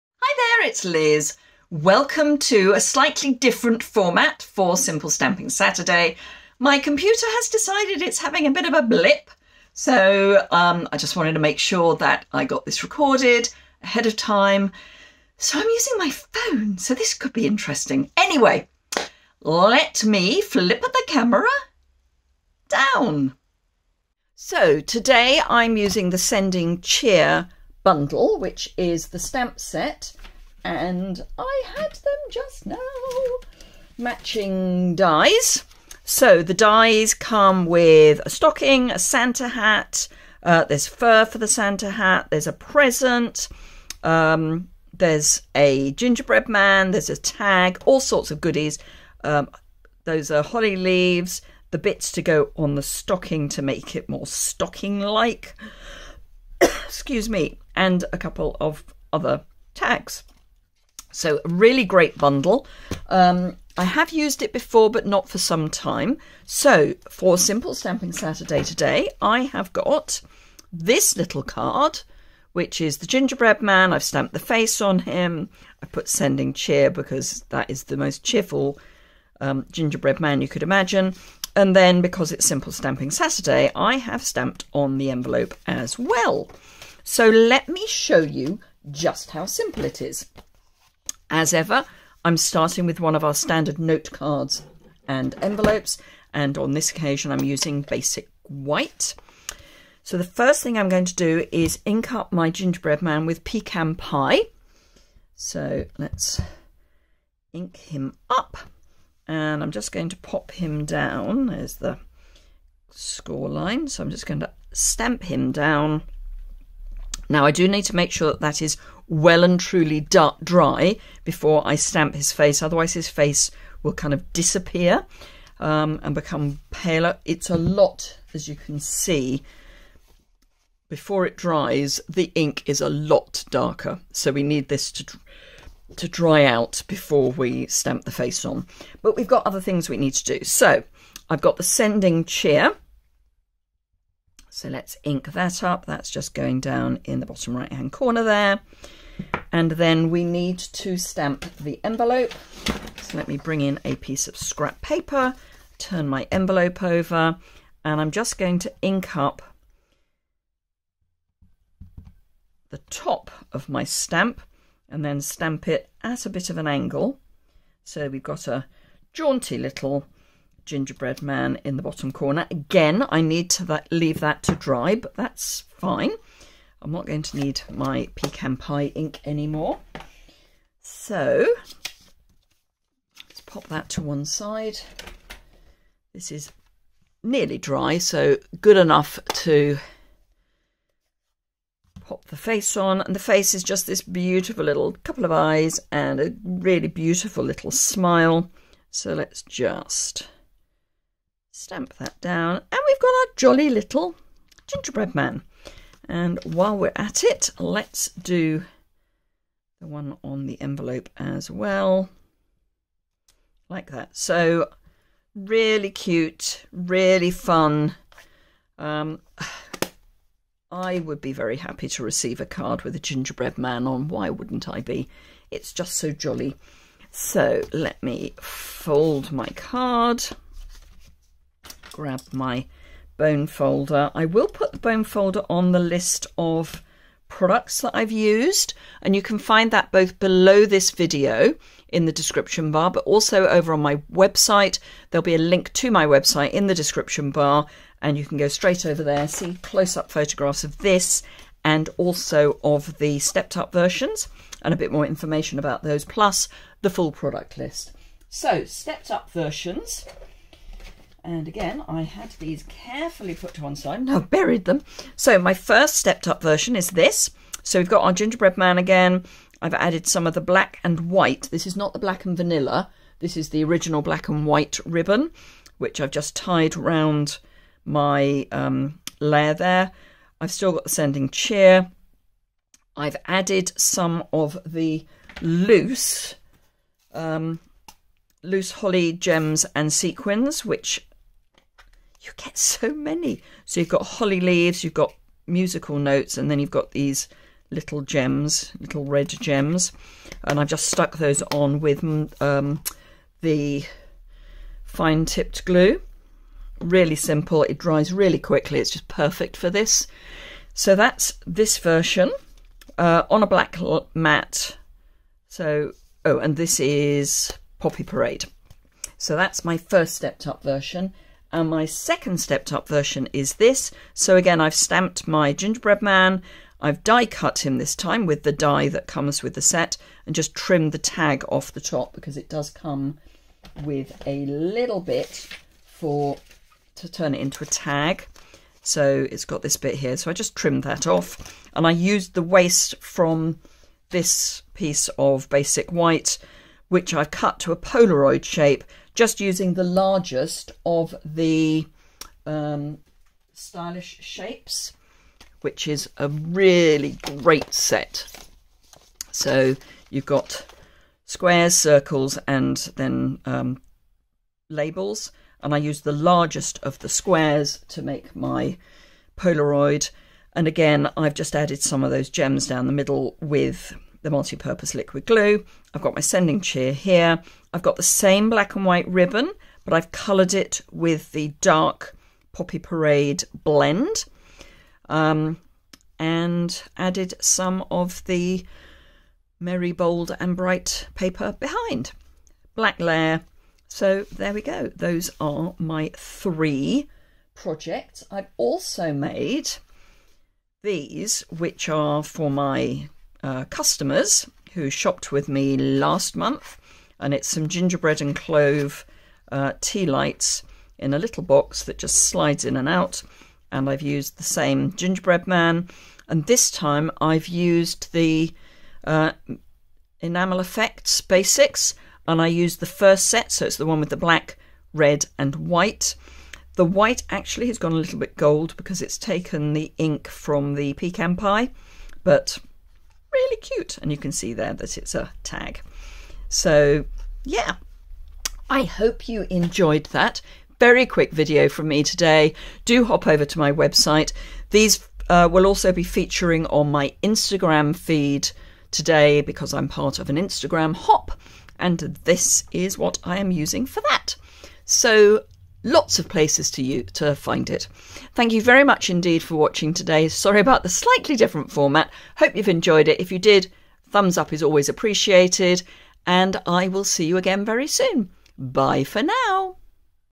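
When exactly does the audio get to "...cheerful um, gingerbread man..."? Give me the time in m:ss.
1:18.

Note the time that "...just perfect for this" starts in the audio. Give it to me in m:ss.
5:08.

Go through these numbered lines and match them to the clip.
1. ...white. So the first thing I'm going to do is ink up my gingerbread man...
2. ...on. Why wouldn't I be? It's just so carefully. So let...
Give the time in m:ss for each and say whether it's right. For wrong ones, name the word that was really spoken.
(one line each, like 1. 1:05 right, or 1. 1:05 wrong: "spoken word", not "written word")
1. 1:38 right
2. 3:43 wrong: "jolly", not "carefully".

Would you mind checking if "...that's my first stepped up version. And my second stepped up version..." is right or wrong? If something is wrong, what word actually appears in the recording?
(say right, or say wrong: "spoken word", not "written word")
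right.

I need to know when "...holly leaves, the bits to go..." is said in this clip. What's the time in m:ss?
0:50.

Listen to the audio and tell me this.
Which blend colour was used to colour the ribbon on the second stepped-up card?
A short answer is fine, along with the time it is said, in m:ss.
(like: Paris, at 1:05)
Dark Poppy Parade, at 6:21.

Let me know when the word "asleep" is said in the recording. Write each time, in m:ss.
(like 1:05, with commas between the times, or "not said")
not said.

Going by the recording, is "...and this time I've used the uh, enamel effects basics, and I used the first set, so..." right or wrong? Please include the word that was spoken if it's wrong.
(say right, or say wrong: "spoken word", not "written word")
right.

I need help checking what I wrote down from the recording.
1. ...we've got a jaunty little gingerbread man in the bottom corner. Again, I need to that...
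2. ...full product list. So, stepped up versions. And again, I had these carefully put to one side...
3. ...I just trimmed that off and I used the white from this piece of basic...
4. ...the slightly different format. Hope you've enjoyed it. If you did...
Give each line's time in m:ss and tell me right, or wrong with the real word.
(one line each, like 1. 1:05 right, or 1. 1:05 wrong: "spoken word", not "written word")
1. 2:48 right
2. 4:16 right
3. 5:40 wrong: "waste", not "white"
4. 7:40 right.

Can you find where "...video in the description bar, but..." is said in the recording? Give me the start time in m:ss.
4:00.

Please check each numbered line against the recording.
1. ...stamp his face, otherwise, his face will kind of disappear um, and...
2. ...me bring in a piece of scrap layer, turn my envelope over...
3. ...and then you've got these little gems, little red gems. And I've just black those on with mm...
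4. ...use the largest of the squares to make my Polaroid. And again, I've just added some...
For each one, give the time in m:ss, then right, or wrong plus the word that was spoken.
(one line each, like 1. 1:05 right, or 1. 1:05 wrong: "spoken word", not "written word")
1. 2:01 right
2. 2:33 wrong: "paper", not "layer"
3. 4:56 wrong: "stuck", not "black"
4. 6:05 right.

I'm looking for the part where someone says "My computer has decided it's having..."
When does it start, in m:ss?
0:06.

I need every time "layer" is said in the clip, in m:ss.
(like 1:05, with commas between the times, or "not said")
4:39, 6:32.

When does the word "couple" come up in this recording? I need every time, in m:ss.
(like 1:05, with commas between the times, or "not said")
0:58, 3:15.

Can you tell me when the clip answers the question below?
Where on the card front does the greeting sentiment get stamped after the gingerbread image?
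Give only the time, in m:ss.
2:27.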